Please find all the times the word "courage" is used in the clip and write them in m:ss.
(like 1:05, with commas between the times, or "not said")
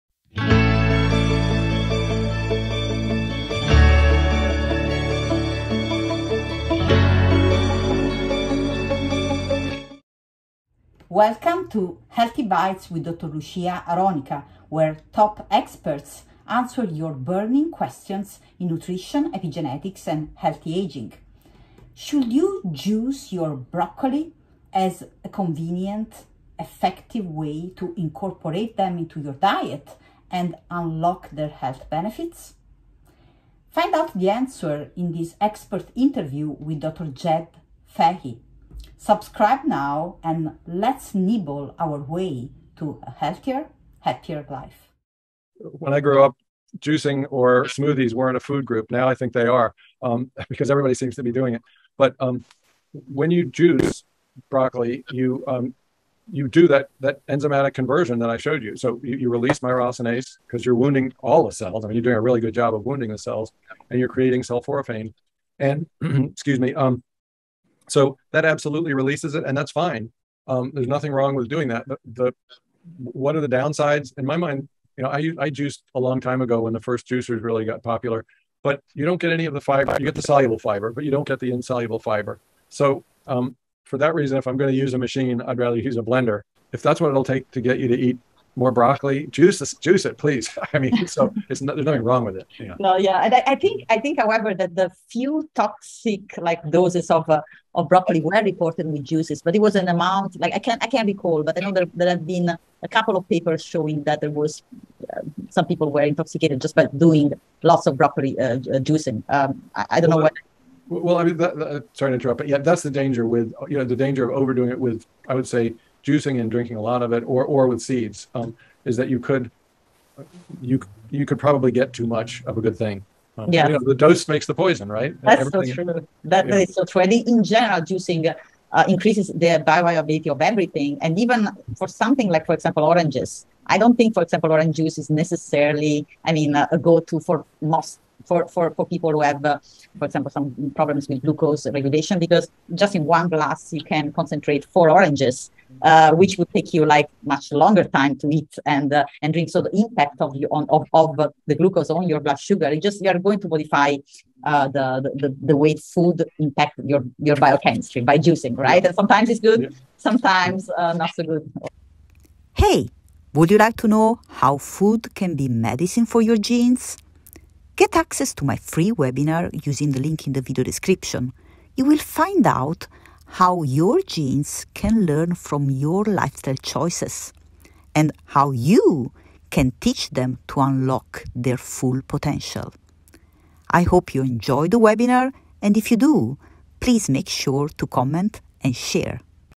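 not said.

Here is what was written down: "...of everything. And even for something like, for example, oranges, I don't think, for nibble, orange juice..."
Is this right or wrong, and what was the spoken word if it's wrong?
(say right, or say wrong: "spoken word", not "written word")
wrong: "example", not "nibble".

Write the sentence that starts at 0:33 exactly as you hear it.
Find out the answer in this expert interview with Dr.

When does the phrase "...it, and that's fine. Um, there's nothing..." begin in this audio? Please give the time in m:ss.
1:09.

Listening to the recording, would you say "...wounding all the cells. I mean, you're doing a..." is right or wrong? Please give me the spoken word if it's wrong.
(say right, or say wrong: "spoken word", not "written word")
right.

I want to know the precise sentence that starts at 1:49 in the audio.
Um, I, I, don't well, know what.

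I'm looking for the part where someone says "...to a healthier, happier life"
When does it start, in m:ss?
0:42.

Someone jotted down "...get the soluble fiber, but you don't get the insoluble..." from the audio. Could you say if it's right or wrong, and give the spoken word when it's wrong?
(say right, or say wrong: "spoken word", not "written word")
right.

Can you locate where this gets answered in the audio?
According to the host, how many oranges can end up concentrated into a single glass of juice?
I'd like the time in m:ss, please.
2:24.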